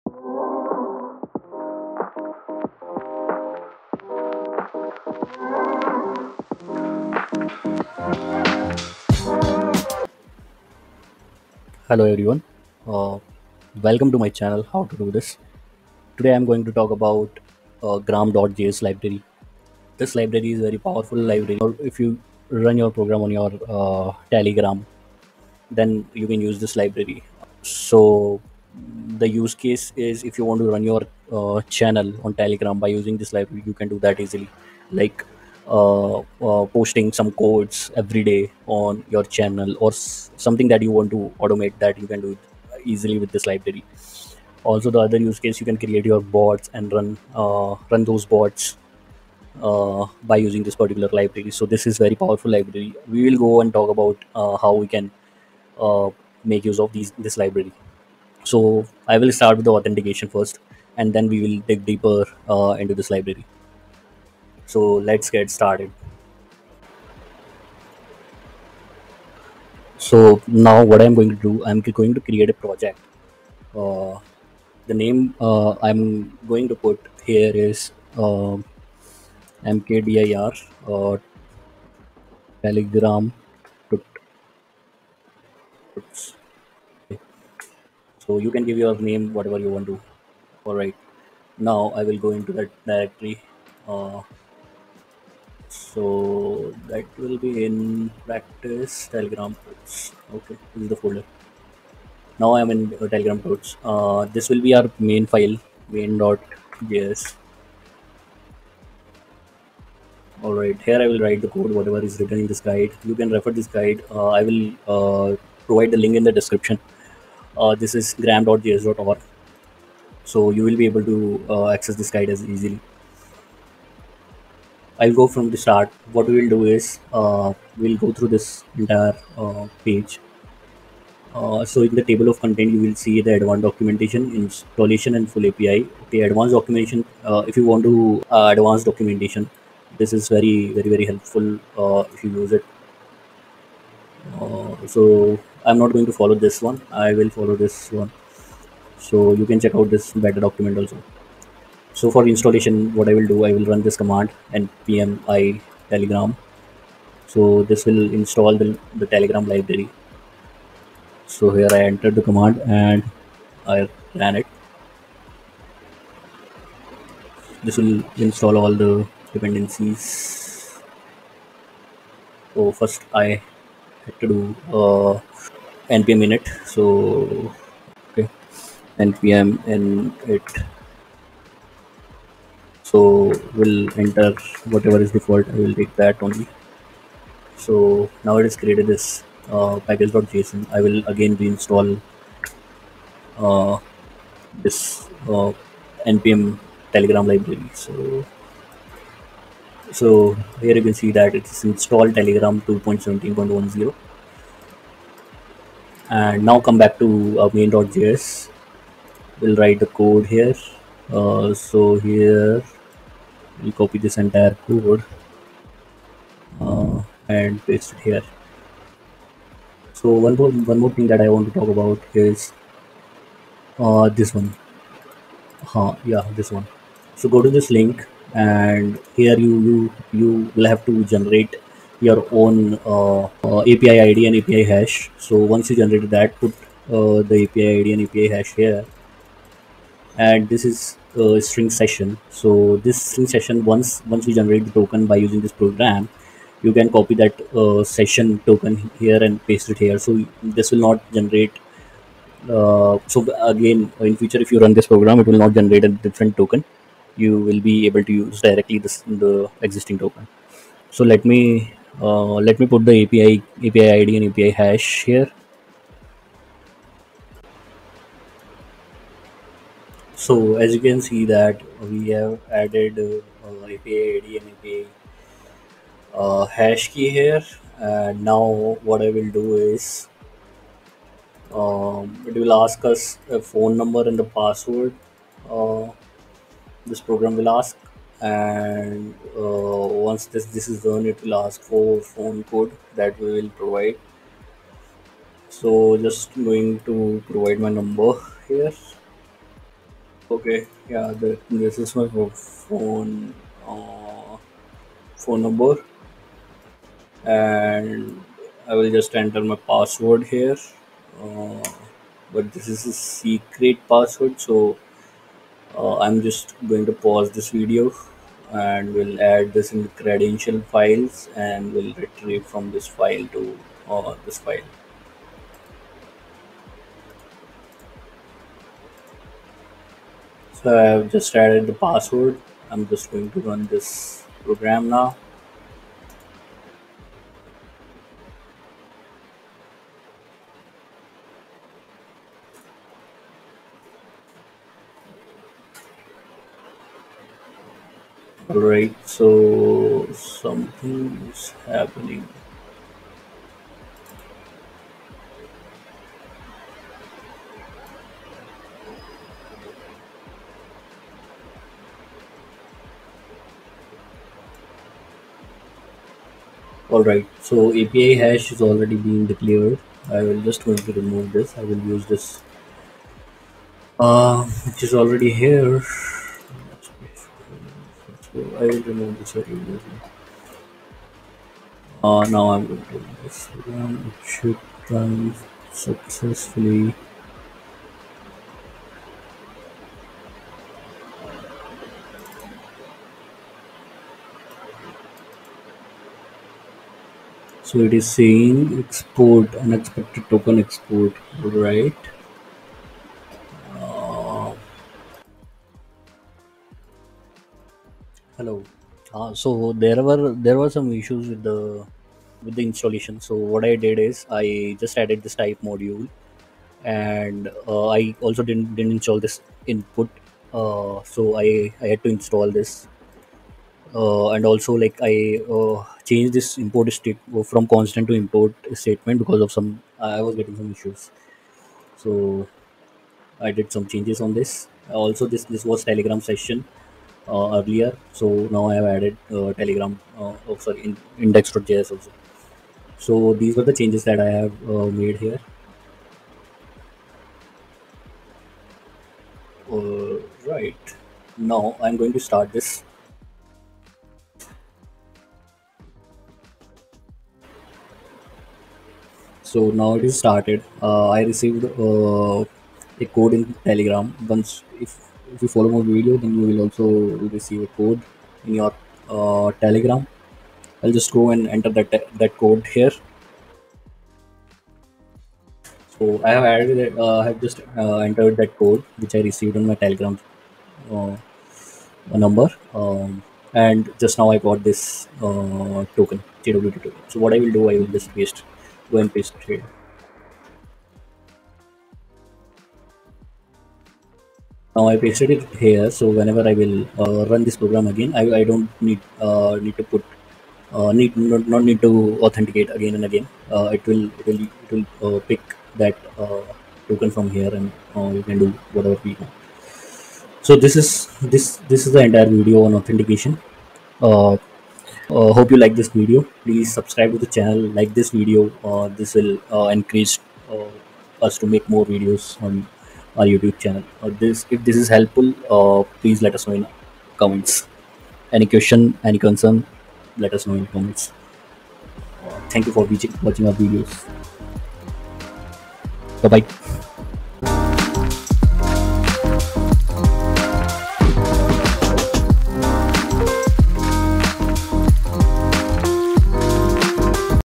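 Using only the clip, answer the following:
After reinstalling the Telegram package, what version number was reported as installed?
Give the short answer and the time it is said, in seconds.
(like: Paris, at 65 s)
2.17.10, at 202 s.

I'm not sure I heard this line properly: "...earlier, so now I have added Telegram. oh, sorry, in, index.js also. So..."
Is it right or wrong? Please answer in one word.
right.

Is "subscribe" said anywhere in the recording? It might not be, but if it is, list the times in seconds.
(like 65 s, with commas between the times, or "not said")
516 s.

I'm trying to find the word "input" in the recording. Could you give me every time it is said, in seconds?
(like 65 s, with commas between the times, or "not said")
419 s.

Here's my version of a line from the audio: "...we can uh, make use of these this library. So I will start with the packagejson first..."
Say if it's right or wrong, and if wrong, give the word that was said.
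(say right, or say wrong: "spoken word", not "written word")
wrong: "authentication", not "packagejson".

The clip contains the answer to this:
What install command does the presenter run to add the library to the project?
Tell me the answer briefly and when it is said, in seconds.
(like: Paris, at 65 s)
npm i telegram, at 154 s.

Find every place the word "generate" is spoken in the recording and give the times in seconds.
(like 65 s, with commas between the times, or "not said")
231 s, 235 s, 244 s, 251 s, 255 s.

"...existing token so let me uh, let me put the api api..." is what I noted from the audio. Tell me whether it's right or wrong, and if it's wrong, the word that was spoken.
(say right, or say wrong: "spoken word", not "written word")
right.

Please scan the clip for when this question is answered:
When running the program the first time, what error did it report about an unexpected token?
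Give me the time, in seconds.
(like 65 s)
399 s.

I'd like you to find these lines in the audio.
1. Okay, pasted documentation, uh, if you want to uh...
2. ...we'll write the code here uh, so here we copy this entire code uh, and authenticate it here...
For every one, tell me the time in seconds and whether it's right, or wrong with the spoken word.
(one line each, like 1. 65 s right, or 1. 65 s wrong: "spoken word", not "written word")
1. 136 s wrong: "advanced", not "pasted"
2. 209 s wrong: "paste", not "authenticate".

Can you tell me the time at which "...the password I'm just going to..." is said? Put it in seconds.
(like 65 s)
331 s.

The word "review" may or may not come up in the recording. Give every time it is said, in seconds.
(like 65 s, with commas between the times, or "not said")
not said.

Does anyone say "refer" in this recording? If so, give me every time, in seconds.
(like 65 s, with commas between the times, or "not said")
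113 s.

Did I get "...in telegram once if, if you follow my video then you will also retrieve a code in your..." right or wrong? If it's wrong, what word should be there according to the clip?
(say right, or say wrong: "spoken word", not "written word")
wrong: "receive", not "retrieve".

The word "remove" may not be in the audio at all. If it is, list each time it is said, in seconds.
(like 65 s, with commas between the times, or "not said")
370 s, 378 s.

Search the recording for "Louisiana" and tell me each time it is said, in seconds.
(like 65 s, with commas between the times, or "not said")
not said.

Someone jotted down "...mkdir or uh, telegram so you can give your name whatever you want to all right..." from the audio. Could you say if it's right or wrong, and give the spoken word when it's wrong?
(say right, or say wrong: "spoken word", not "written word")
right.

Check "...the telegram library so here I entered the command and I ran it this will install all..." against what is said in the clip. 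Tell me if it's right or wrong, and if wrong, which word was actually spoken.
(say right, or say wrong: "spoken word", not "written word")
right.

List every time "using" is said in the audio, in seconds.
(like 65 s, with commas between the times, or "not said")
32 s, 50 s, 245 s.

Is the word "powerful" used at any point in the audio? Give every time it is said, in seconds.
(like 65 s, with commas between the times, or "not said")
20 s, 52 s.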